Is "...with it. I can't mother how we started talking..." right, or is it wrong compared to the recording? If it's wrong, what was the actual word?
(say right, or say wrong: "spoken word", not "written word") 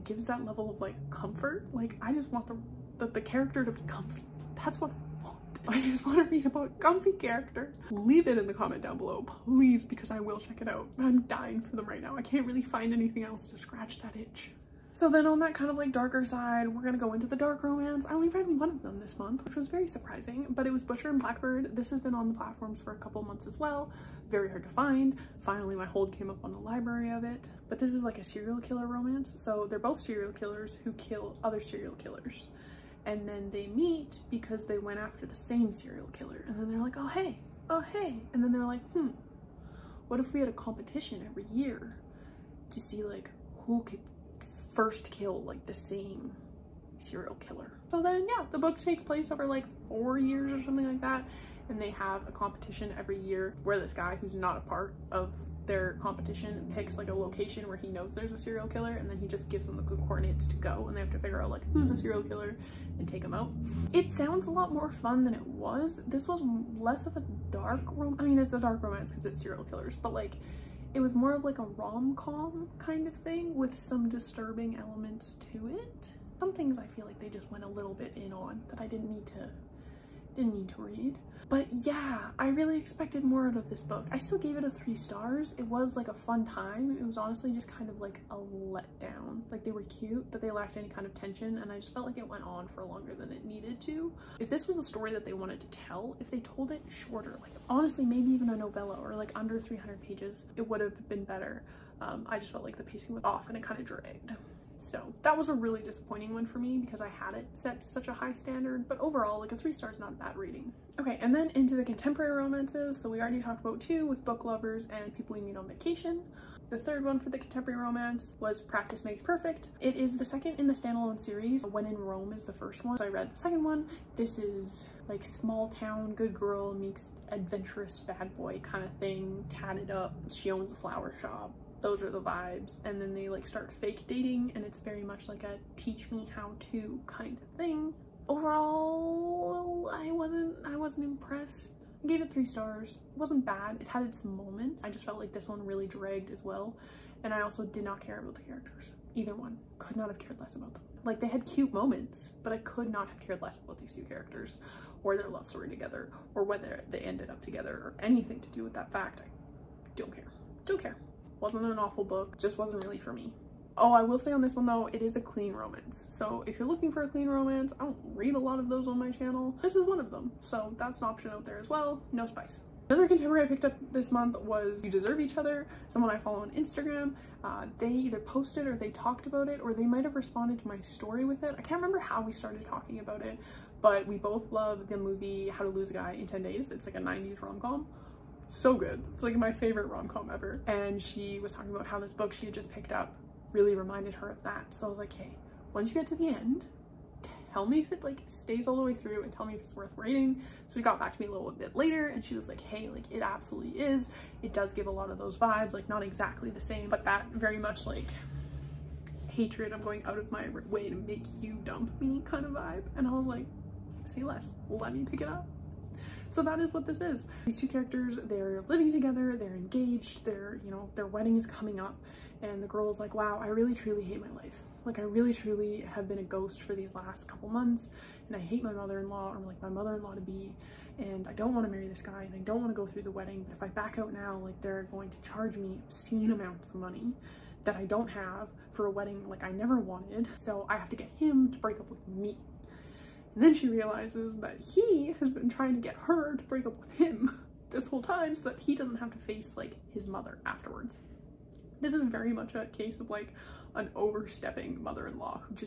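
wrong: "remember", not "mother".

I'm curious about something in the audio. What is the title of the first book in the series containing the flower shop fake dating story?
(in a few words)
When in Rome.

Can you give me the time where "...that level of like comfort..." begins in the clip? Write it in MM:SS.
00:00.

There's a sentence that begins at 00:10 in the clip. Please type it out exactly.
I'm dying for them right now.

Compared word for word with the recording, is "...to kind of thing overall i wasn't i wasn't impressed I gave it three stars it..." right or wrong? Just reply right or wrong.
right.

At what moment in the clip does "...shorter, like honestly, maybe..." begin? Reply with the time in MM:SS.
01:36.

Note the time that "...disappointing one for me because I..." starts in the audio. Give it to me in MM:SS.
01:45.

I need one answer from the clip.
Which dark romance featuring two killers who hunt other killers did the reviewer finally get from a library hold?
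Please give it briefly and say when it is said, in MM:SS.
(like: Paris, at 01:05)
Butcher and Blackbird, at 00:20.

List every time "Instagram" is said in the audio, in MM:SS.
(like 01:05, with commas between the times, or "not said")
02:56.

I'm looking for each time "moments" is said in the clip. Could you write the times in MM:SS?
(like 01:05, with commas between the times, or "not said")
02:24, 02:31.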